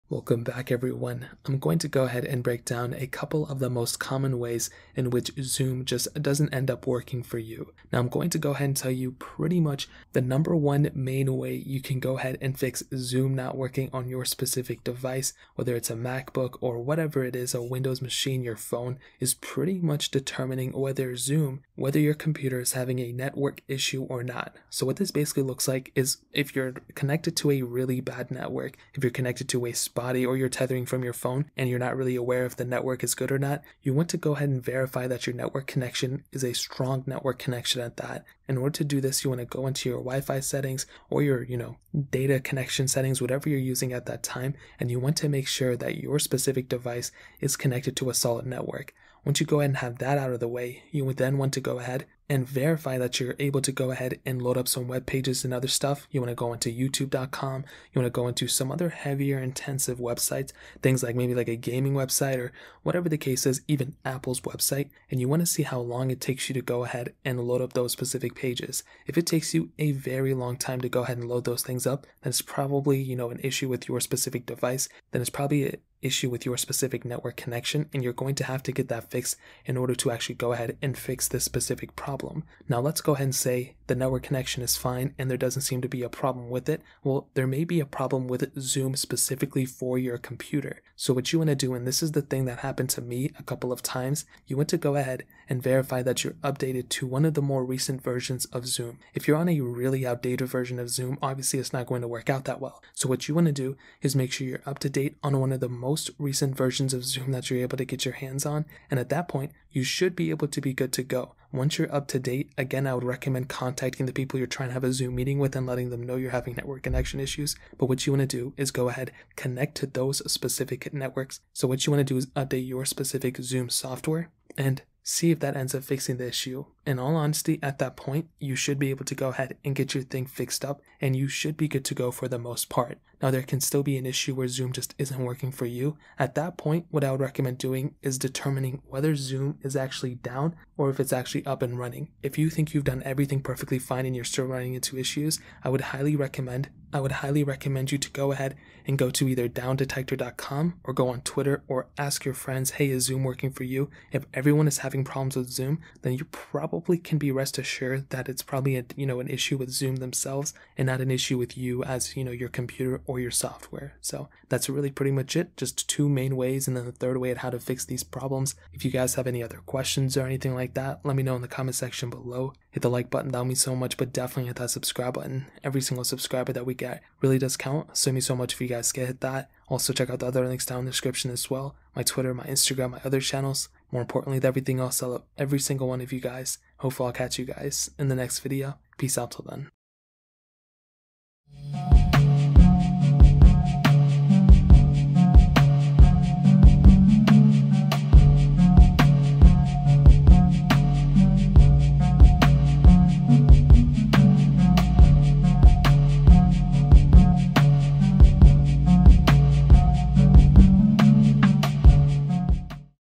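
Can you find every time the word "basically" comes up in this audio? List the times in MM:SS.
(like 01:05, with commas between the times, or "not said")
00:25.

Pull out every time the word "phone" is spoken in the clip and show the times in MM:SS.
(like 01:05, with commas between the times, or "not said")
00:18, 00:31.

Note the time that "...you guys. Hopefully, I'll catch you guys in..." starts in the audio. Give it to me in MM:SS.
03:06.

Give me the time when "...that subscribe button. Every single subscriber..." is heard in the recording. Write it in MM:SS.
02:54.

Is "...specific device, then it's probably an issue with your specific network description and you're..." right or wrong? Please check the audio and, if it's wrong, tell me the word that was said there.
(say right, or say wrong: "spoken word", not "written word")
wrong: "connection", not "description".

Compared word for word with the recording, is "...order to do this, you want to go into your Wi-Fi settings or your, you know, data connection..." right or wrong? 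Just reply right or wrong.
right.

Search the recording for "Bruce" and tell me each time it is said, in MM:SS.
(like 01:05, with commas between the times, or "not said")
not said.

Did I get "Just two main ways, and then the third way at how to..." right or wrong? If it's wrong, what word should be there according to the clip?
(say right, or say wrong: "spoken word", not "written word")
right.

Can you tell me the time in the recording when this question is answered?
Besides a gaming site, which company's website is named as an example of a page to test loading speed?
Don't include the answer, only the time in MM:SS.
01:04.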